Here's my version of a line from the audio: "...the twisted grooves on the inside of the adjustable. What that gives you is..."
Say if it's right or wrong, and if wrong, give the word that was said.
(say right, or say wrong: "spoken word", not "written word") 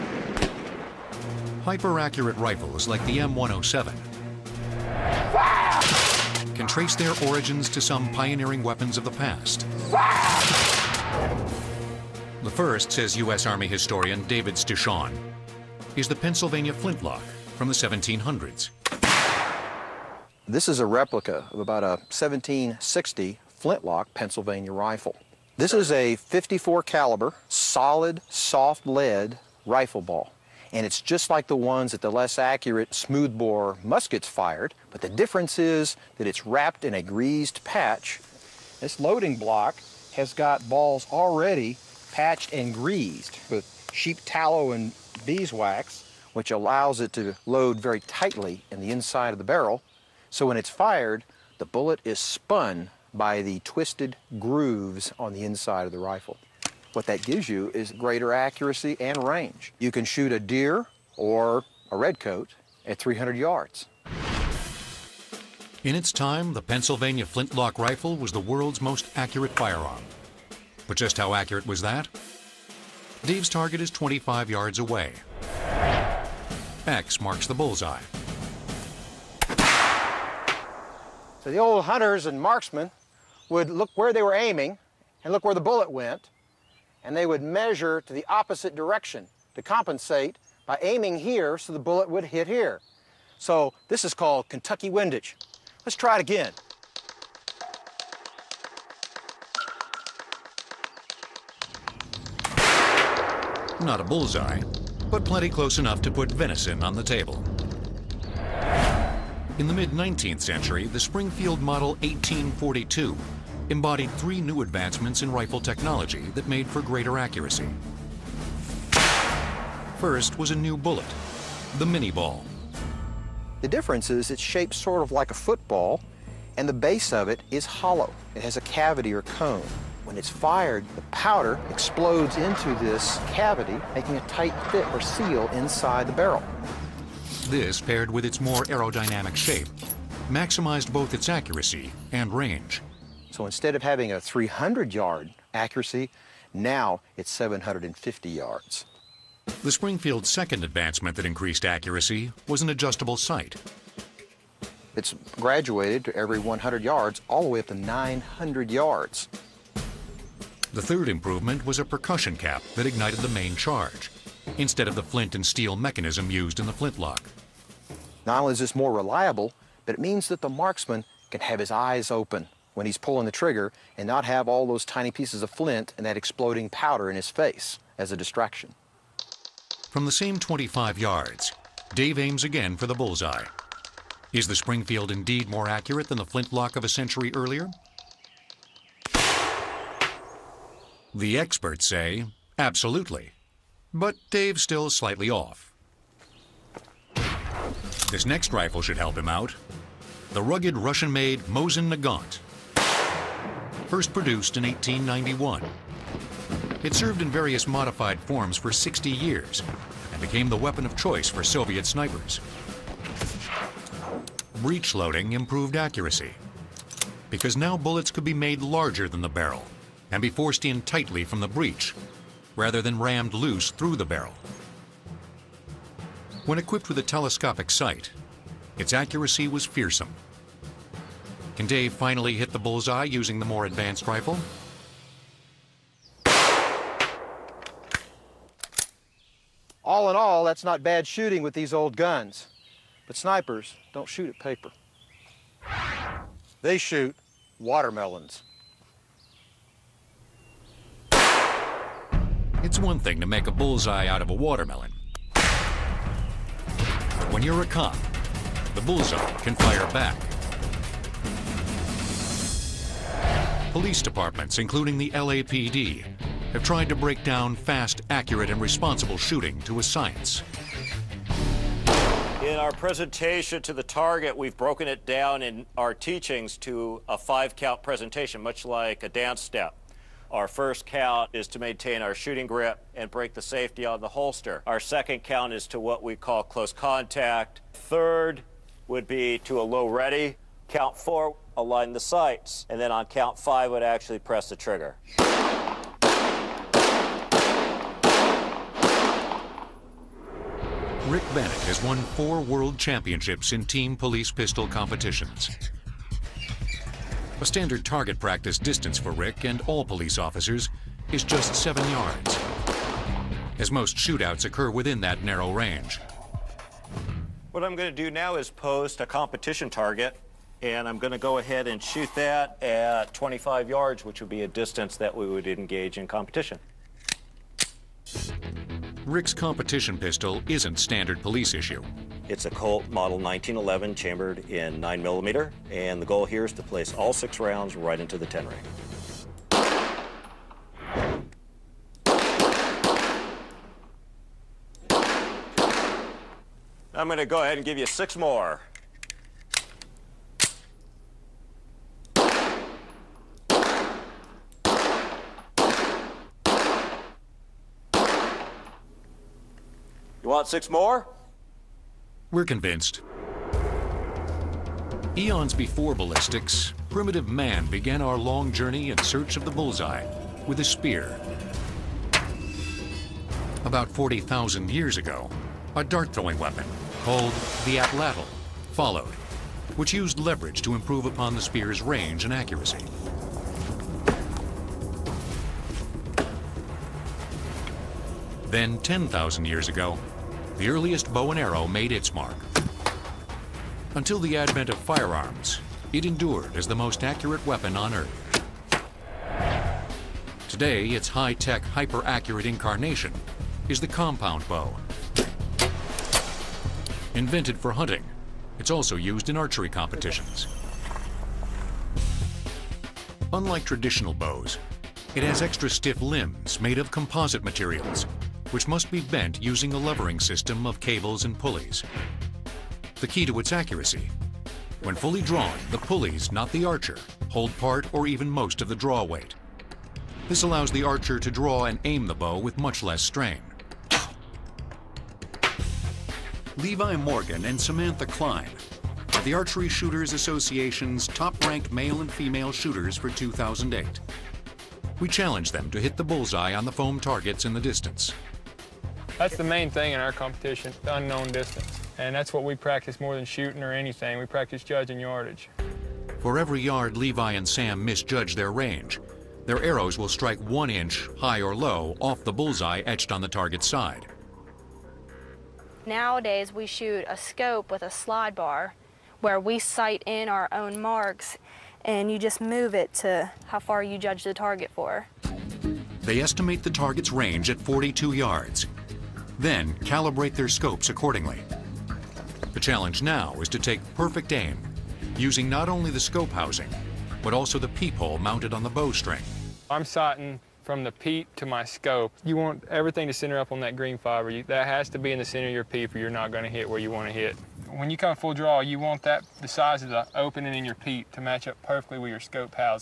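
wrong: "rifle", not "adjustable".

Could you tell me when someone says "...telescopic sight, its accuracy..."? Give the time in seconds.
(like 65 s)
227 s.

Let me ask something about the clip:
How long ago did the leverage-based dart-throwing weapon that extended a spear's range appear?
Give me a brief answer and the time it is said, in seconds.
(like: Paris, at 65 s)
40,000 years, at 373 s.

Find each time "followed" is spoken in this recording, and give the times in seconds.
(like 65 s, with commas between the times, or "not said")
378 s.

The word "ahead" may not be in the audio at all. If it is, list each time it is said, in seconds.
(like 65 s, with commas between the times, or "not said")
321 s, 347 s.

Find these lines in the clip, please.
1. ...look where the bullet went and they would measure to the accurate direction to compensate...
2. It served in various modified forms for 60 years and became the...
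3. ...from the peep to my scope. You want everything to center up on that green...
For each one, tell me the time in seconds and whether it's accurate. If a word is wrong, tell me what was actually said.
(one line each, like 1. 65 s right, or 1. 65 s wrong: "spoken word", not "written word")
1. 85 s wrong: "opposite", not "accurate"
2. 206 s right
3. 490 s right.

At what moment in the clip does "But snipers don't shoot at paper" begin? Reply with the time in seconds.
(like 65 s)
243 s.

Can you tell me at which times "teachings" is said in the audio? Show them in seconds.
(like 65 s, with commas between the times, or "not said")
275 s.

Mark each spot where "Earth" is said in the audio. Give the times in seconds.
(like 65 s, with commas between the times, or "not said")
397 s.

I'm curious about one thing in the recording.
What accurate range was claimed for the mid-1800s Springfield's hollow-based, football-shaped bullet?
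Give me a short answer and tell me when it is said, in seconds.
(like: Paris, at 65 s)
750 yards, at 147 s.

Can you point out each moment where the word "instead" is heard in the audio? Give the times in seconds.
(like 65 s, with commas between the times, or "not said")
143 s, 164 s.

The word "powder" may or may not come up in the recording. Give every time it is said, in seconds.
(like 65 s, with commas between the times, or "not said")
131 s, 176 s.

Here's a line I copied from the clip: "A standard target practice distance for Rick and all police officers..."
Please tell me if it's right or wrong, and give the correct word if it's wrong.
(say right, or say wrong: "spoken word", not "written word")
right.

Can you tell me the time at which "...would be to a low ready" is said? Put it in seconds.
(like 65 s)
288 s.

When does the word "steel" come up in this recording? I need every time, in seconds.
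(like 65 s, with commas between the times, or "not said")
165 s.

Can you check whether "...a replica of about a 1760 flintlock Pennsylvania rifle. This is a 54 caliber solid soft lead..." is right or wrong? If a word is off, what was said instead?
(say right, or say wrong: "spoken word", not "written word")
right.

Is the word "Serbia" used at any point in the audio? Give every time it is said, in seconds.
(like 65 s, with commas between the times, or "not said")
not said.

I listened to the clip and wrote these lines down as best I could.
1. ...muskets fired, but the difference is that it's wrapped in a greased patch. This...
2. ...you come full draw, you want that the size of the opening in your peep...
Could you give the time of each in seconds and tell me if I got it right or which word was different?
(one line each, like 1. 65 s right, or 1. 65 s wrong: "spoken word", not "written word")
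1. 33 s right
2. 497 s right.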